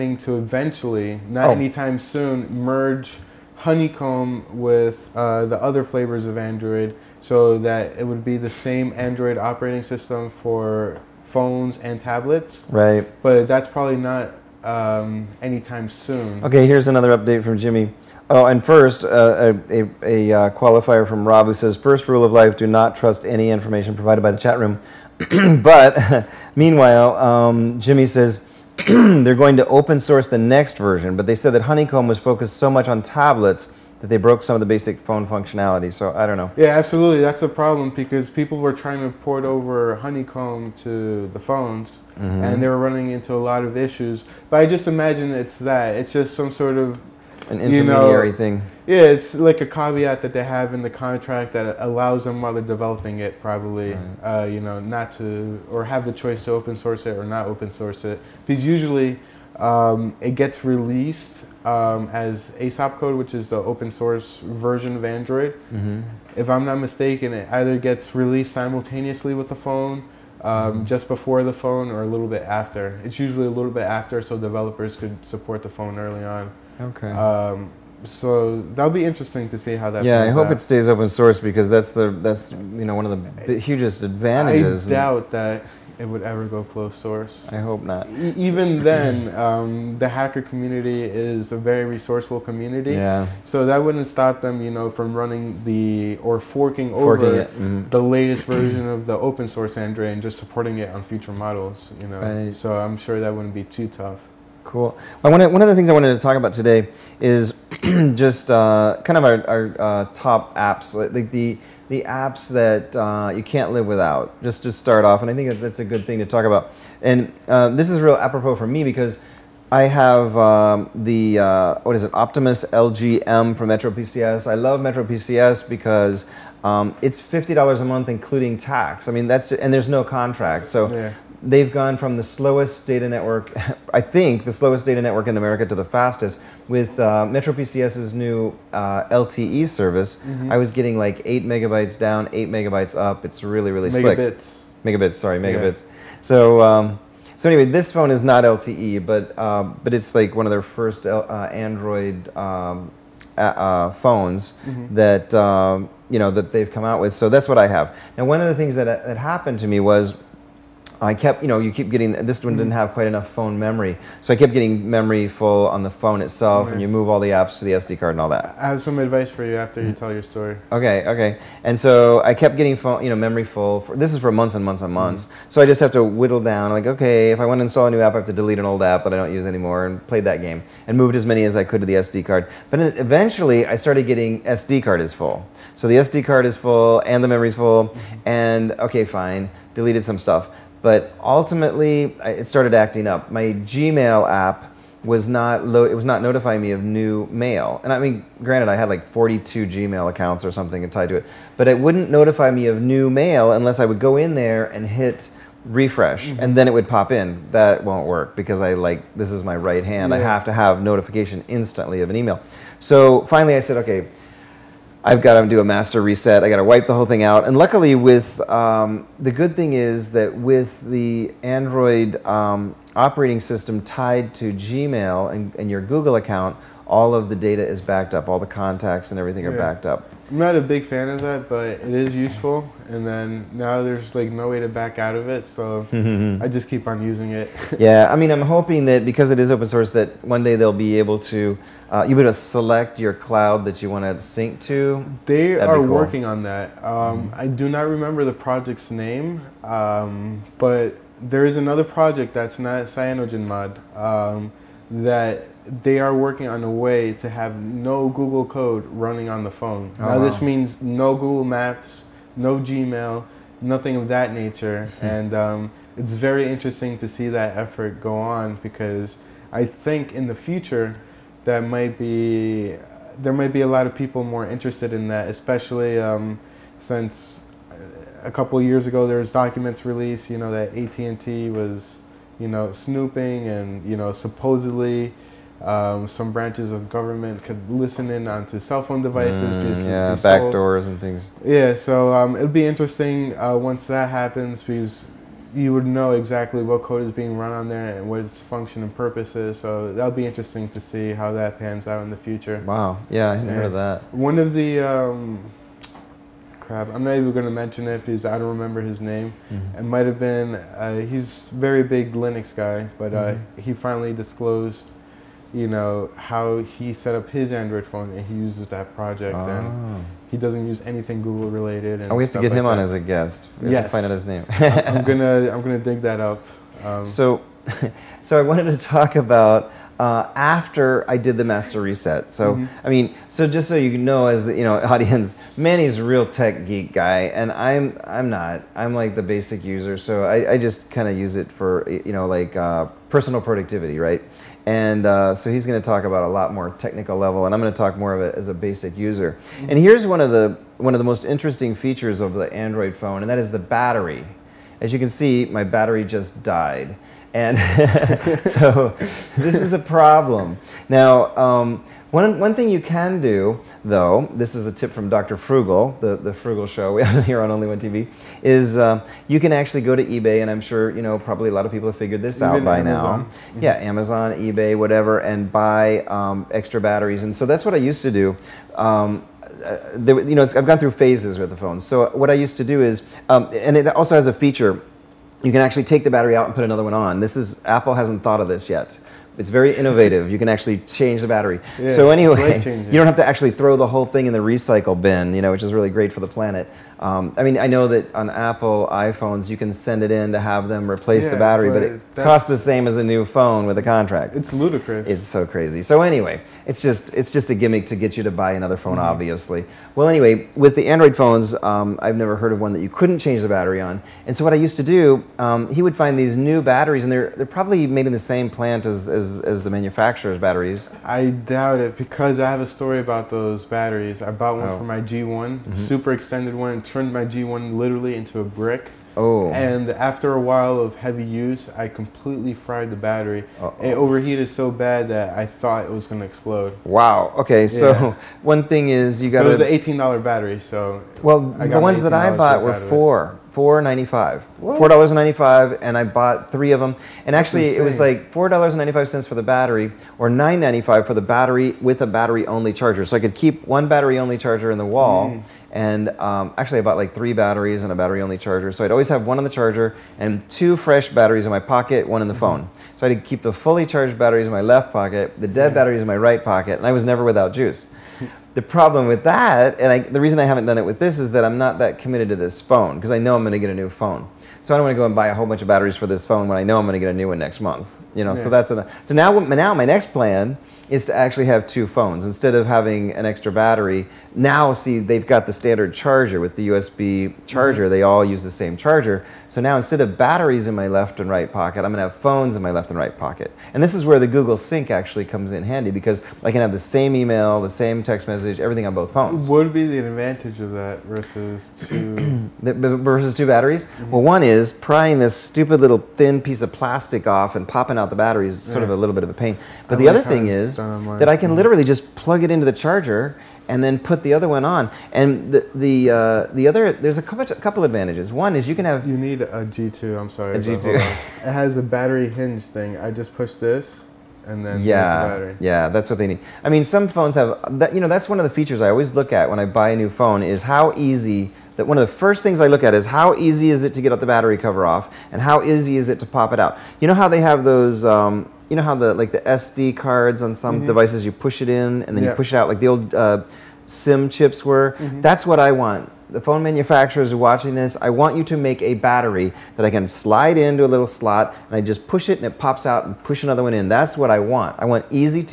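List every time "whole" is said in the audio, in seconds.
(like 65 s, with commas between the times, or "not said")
216 s, 393 s, 475 s.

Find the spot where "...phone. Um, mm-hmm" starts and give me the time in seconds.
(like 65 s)
69 s.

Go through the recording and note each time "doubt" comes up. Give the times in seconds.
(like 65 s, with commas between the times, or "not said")
84 s, 421 s.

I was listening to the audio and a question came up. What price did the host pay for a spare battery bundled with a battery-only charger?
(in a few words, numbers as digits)
$9.95.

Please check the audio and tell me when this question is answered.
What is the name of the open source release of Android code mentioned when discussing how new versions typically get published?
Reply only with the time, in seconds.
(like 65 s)
62 s.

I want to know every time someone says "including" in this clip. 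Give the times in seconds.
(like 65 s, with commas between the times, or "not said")
128 s.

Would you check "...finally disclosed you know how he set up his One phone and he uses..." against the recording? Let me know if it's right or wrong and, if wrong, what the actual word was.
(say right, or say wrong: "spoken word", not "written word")
wrong: "Android", not "One".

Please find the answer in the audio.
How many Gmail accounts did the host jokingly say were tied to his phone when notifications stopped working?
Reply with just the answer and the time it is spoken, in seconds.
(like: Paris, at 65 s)
42, at 199 s.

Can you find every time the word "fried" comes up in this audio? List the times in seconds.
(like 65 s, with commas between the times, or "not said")
432 s.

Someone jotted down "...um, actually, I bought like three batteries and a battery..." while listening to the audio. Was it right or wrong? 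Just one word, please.
right.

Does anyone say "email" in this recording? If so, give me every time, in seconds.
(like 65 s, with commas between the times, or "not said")
212 s, 497 s.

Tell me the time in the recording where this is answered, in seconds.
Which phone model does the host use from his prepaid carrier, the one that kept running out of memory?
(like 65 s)
122 s.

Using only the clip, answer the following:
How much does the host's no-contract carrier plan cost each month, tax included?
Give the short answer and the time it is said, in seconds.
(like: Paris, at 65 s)
$50, at 127 s.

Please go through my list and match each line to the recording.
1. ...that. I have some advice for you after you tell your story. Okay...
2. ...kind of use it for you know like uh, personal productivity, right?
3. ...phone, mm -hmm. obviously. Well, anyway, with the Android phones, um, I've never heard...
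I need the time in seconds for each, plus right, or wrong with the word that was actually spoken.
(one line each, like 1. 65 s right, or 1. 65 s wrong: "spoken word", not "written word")
1. 168 s right
2. 340 s right
3. 408 s right.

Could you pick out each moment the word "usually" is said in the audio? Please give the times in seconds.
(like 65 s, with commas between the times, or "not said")
58 s, 73 s.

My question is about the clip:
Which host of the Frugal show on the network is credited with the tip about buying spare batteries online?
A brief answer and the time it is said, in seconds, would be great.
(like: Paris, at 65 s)
Dr. Frugal, at 365 s.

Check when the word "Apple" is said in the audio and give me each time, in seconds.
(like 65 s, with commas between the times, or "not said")
387 s, 398 s.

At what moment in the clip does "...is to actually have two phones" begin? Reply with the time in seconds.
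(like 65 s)
480 s.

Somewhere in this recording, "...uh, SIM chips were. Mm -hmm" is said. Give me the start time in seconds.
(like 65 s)
543 s.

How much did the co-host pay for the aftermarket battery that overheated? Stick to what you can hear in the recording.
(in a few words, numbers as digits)
$18.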